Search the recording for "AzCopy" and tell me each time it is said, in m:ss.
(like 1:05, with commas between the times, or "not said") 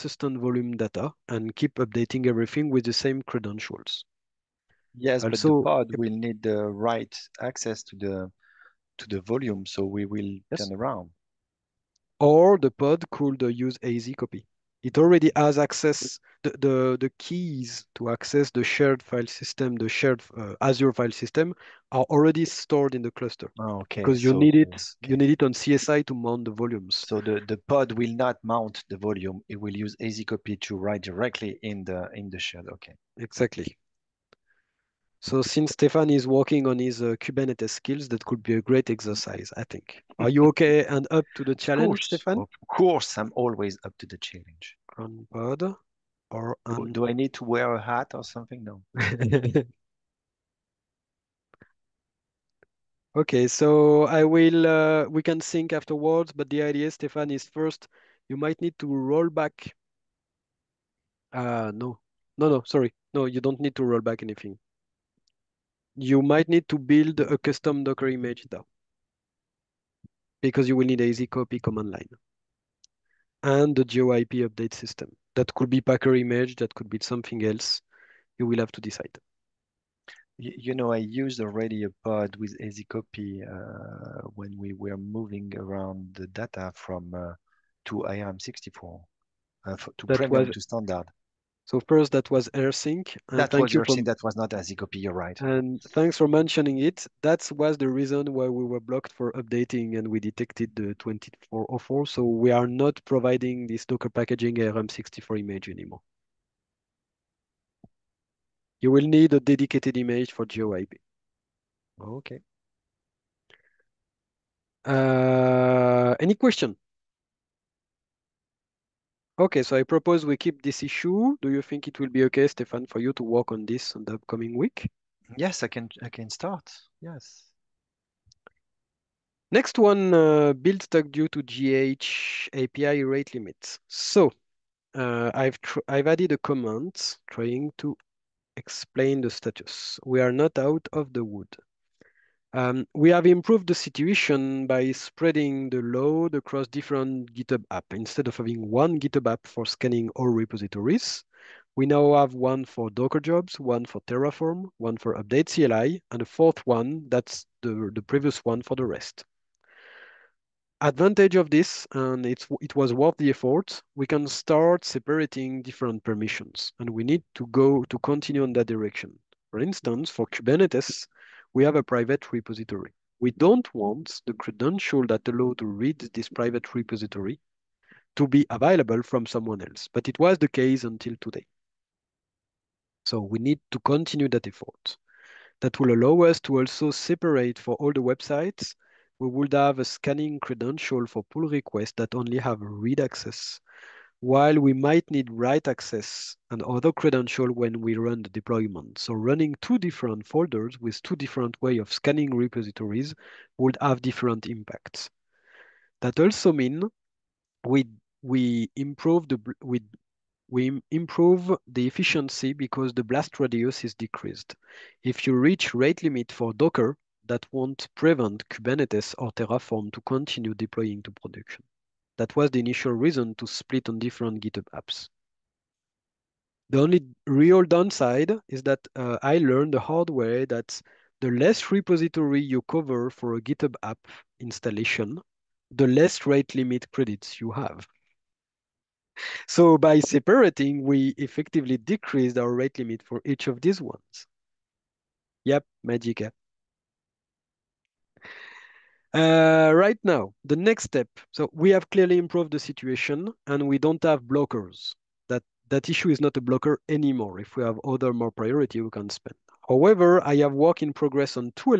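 0:13, 1:22, 1:34.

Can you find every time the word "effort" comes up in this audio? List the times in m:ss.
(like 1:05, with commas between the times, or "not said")
2:43, 3:04.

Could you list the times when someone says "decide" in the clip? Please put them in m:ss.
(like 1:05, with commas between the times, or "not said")
1:18.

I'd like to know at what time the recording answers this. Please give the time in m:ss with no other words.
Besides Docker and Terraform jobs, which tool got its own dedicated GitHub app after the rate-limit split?
2:35.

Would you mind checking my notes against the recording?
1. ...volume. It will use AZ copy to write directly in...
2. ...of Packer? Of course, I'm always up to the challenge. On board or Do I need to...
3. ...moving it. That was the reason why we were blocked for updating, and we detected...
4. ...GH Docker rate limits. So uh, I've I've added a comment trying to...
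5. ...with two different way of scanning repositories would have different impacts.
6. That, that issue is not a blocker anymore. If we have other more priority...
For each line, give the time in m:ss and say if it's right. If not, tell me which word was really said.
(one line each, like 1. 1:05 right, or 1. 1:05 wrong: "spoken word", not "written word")
1. 0:28 right
2. 0:42 wrong: "Stefan", not "Packer"
3. 1:36 wrong: "mentioning", not "moving"
4. 2:11 wrong: "API", not "Docker"
5. 3:20 right
6. 4:15 right.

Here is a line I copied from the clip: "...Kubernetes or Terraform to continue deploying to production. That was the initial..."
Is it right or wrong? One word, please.
right.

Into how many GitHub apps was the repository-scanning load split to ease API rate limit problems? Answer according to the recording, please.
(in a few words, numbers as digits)
4.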